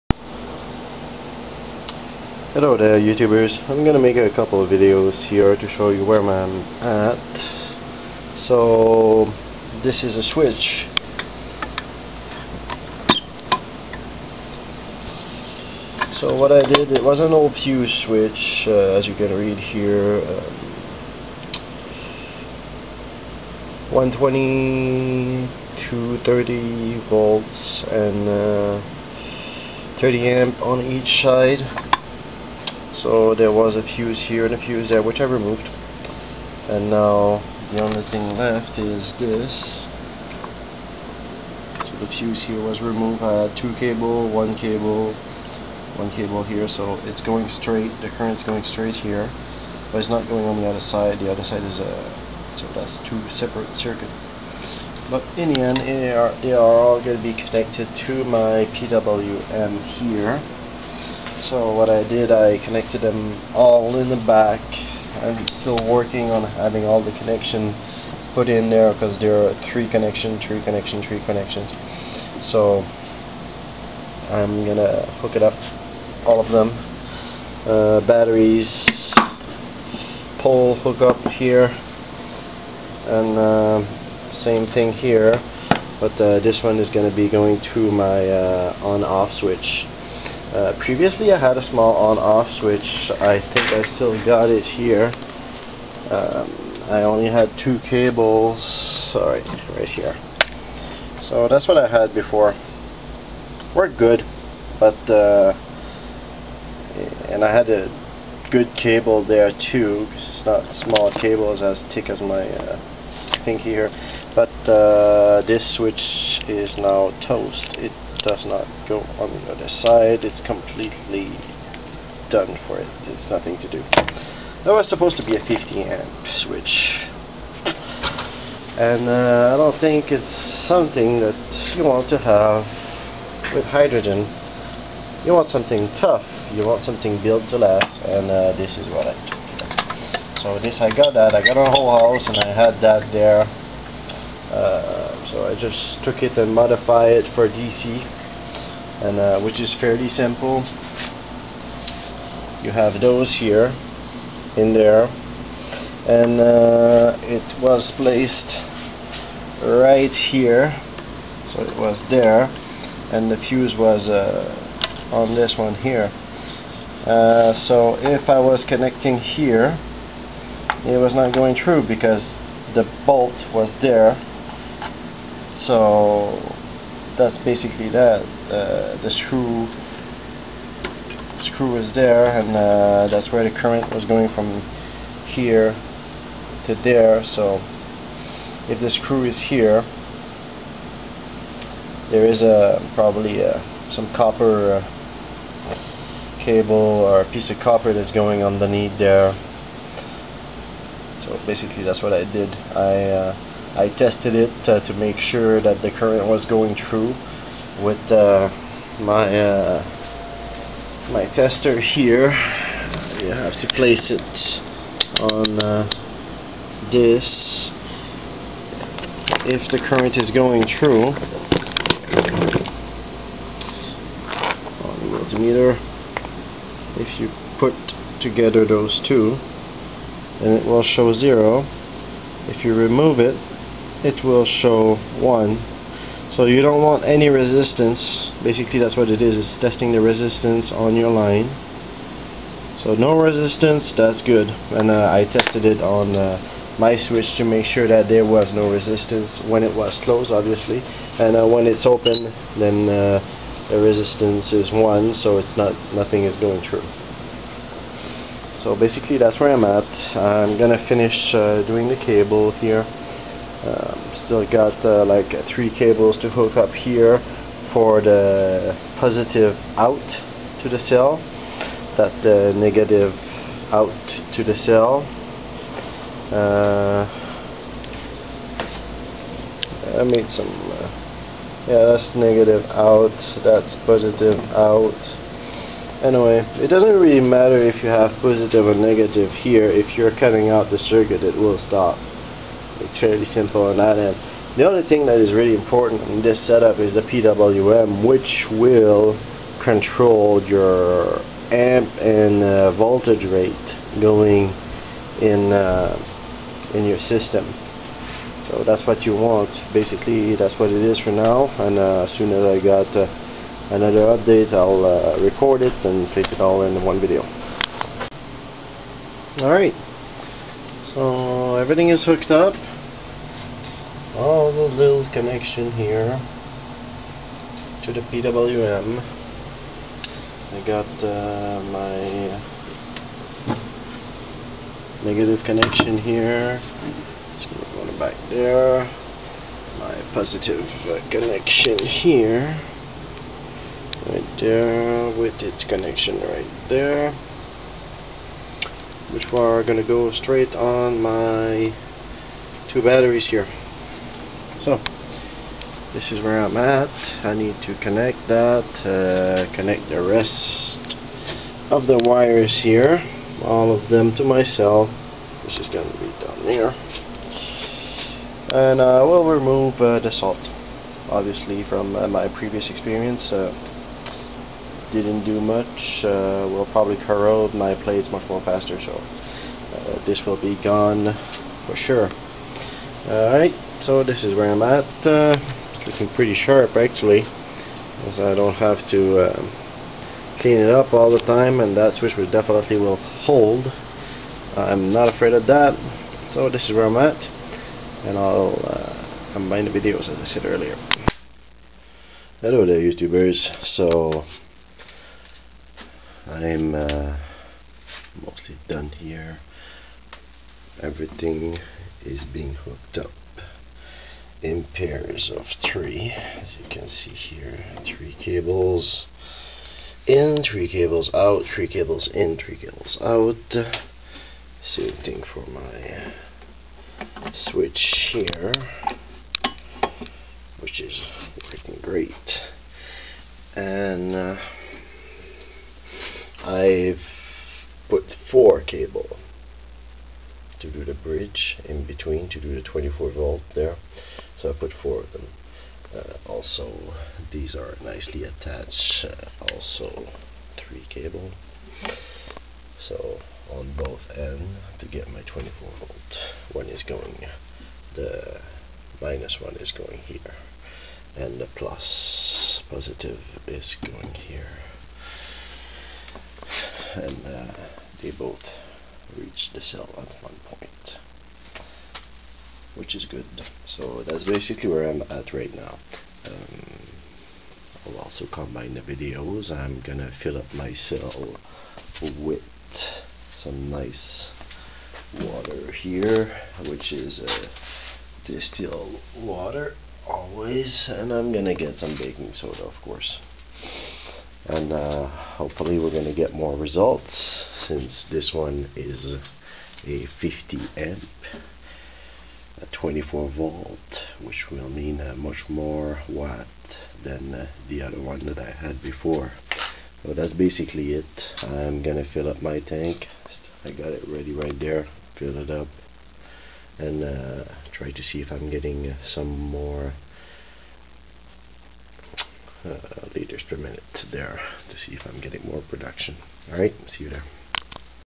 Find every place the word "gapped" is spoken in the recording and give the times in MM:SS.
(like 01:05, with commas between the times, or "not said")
not said.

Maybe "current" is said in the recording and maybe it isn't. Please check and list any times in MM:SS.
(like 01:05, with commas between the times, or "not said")
00:48, 03:03, 03:25, 03:39.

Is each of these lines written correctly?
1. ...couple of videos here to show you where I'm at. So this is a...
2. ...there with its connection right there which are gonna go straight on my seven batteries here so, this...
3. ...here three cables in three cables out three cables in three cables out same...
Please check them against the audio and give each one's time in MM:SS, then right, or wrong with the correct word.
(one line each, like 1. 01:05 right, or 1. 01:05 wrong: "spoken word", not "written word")
1. 00:04 right
2. 05:44 wrong: "two", not "seven"
3. 06:57 right.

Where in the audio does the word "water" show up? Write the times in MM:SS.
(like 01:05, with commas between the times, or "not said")
08:05, 08:09.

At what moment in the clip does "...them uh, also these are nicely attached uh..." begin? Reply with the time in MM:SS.
07:25.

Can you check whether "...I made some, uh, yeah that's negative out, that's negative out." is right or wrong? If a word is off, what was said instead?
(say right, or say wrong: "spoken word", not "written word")
wrong: "positive", not "negative".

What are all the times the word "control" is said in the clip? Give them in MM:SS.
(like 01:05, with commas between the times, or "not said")
04:59.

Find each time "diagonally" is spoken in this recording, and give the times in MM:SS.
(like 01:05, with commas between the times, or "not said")
not said.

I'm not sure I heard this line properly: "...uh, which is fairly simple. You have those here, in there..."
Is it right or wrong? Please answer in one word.
right.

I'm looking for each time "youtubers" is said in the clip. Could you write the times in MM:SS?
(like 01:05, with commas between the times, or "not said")
00:02, 06:42.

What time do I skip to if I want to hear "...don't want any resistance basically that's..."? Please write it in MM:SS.
03:56.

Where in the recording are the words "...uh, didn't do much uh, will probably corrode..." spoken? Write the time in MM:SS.
06:13.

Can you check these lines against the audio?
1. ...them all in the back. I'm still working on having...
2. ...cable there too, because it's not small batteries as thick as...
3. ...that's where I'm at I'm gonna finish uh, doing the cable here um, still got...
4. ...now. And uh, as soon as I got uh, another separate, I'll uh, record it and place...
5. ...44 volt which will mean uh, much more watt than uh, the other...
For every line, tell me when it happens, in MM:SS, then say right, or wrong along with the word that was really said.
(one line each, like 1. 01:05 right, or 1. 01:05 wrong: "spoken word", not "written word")
1. 01:03 right
2. 01:48 wrong: "cables", not "batteries"
3. 04:19 right
4. 05:11 wrong: "update", not "separate"
5. 08:22 wrong: "24", not "44".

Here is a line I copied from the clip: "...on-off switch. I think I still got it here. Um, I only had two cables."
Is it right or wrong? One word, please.
right.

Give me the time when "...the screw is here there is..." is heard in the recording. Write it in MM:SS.
03:08.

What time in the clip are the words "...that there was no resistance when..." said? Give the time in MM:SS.
04:07.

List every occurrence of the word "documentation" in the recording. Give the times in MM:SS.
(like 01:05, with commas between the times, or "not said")
not said.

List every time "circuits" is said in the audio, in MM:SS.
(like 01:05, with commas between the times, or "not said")
00:53, 04:50.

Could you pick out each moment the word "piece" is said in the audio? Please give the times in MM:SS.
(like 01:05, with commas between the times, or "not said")
03:17.